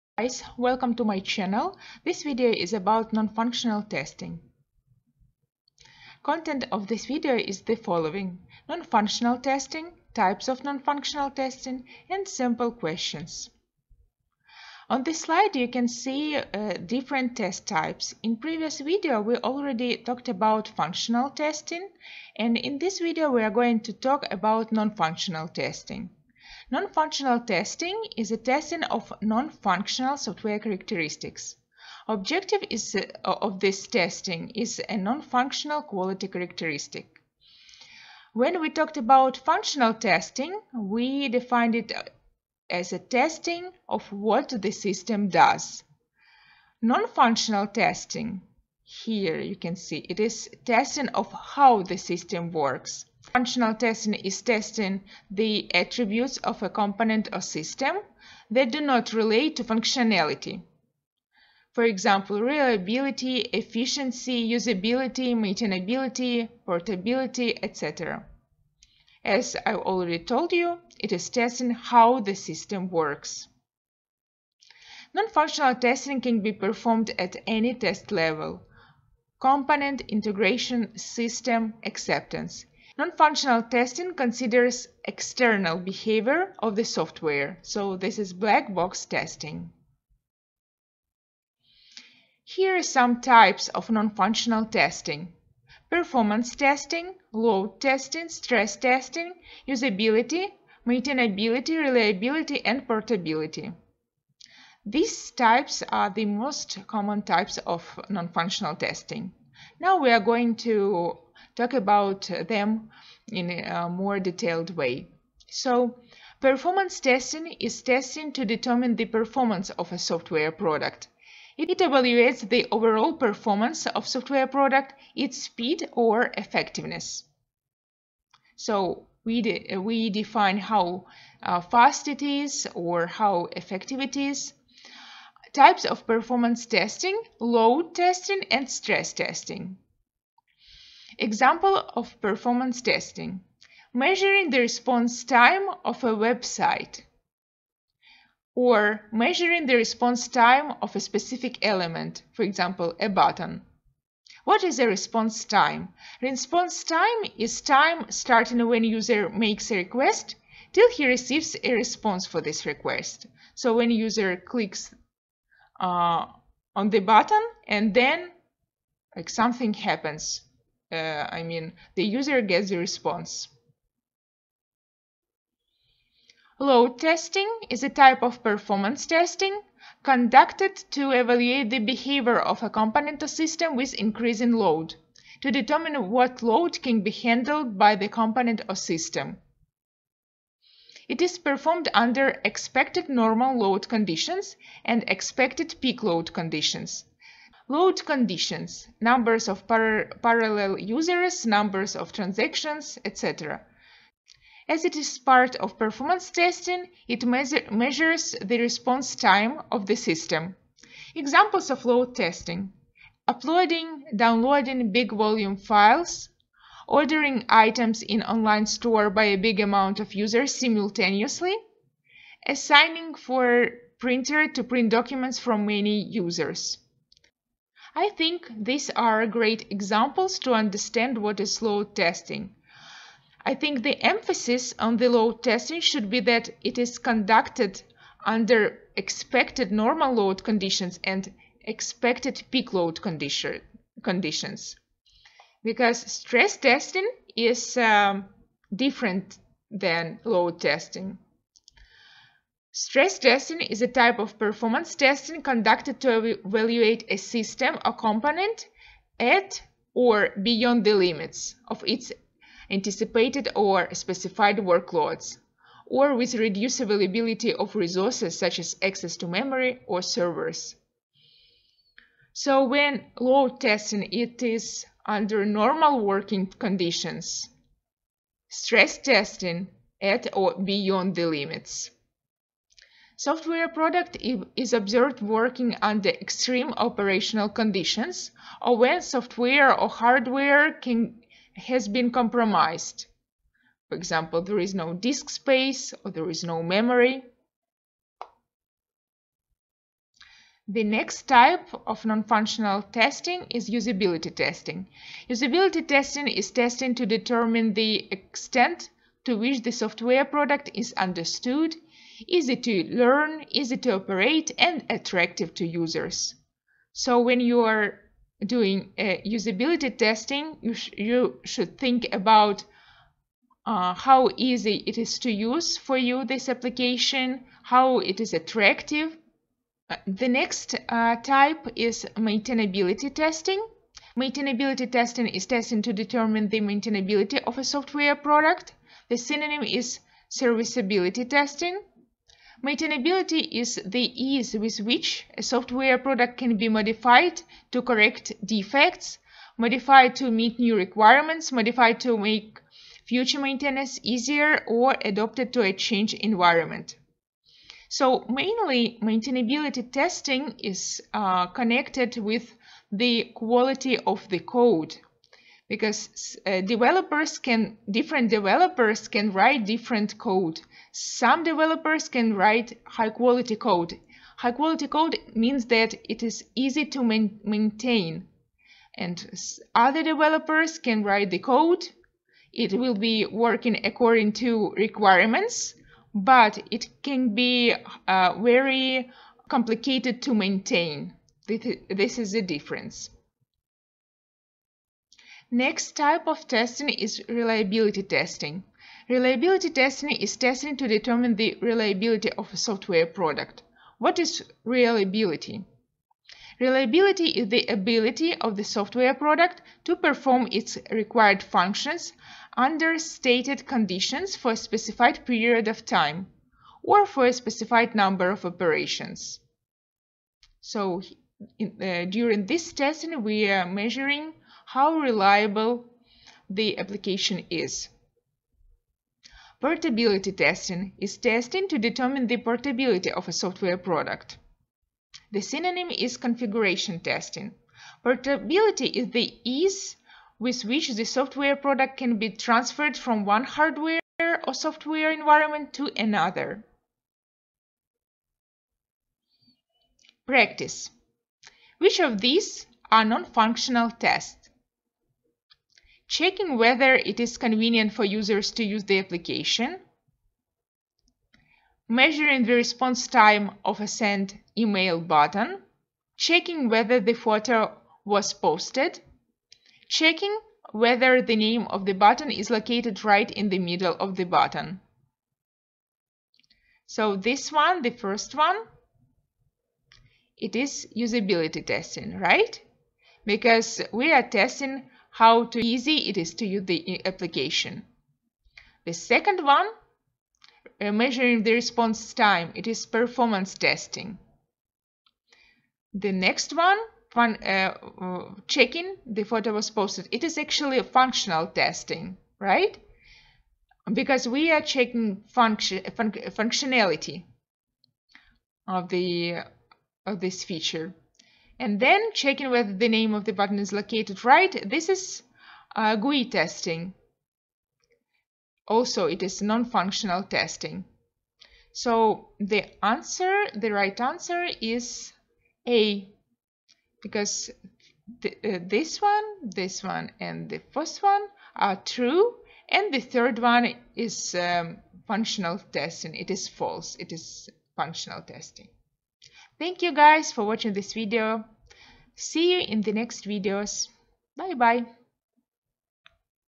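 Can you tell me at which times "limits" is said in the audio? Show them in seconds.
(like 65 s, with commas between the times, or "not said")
260 s, 281 s.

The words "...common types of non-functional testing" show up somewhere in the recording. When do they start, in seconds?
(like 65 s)
106 s.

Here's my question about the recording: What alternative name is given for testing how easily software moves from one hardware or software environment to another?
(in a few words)
Configuration testing.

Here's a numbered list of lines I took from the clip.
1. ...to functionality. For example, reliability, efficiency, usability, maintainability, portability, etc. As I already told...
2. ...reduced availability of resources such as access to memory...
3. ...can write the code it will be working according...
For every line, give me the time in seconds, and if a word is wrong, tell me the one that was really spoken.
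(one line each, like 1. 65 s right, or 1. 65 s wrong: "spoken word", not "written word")
1. 59 s right
2. 266 s right
3. 380 s right.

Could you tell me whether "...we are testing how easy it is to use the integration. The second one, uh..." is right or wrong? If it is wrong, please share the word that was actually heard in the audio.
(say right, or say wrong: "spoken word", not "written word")
wrong: "application", not "integration".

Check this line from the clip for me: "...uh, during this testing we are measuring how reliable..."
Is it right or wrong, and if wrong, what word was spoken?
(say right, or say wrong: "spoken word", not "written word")
right.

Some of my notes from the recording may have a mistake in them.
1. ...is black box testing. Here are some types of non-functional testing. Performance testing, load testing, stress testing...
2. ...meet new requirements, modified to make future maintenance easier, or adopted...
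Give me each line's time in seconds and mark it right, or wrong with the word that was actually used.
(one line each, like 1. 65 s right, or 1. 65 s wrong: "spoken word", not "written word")
1. 88 s right
2. 350 s right.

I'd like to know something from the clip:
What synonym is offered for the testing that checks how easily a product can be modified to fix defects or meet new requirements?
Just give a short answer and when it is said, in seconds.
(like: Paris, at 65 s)
Serviceability testing, at 340 s.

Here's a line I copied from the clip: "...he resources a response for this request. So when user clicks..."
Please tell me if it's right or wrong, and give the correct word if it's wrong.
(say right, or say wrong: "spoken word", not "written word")
wrong: "receives", not "resources".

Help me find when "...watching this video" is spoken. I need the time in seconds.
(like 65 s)
540 s.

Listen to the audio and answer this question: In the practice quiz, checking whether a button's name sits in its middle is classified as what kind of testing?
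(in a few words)
GUI testing.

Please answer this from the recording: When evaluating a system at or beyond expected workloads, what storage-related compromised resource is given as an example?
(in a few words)
No disk space.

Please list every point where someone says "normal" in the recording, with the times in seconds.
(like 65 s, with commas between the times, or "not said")
193 s, 239 s, 275 s.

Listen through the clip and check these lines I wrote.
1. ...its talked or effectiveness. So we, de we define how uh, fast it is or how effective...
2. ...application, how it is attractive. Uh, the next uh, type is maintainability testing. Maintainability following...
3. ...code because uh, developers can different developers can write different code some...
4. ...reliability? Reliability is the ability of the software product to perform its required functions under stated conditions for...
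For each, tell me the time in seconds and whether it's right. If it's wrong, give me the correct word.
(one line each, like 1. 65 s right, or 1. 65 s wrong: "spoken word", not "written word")
1. 125 s wrong: "speed", not "talked"
2. 326 s wrong: "testing", not "following"
3. 364 s right
4. 404 s right.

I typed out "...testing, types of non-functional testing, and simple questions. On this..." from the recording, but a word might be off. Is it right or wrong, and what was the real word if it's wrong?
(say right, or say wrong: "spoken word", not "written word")
right.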